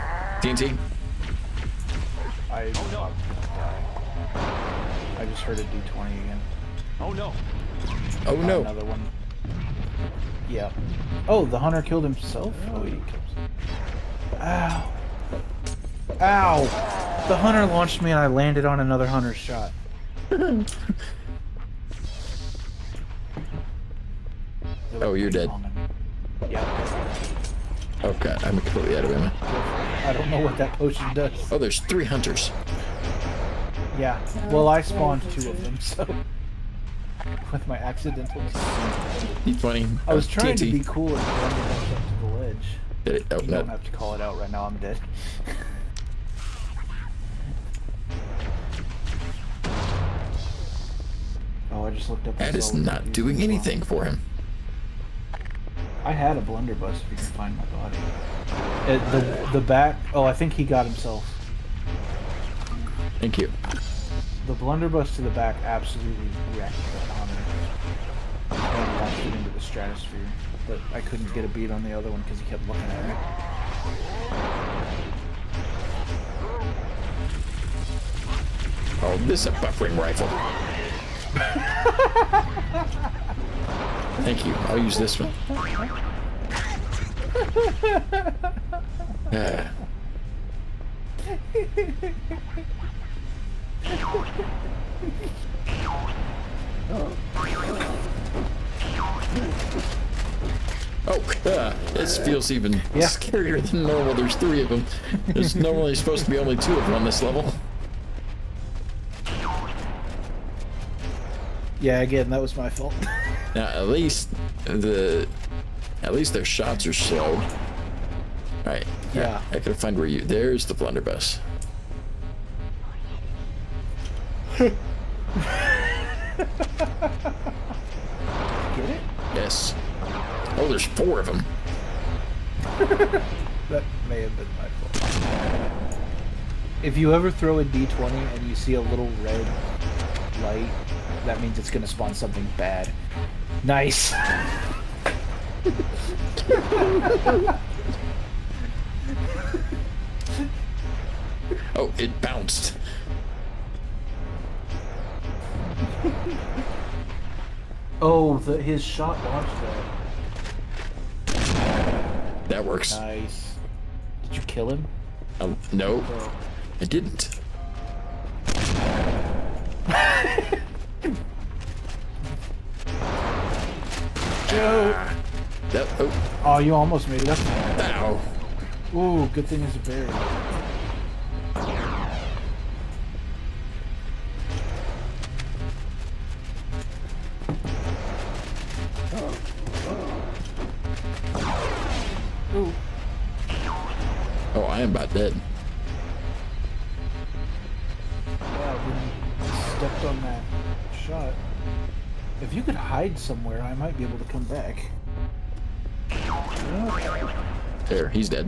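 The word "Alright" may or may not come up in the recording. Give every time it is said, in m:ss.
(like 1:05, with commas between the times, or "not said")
1:58.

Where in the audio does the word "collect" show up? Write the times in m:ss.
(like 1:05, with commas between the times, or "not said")
not said.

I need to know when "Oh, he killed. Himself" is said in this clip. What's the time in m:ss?
0:12.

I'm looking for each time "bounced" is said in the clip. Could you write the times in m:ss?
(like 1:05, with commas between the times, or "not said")
2:32.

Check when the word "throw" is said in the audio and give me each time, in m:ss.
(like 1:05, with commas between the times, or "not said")
2:17.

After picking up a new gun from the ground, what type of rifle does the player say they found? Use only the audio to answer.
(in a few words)
buffering rifle.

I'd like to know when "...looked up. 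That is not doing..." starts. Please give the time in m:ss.
0:52.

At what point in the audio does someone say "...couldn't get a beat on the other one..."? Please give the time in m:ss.
1:11.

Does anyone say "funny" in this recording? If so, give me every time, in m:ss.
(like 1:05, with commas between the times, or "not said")
0:39.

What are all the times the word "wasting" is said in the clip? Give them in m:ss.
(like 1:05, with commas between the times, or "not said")
not said.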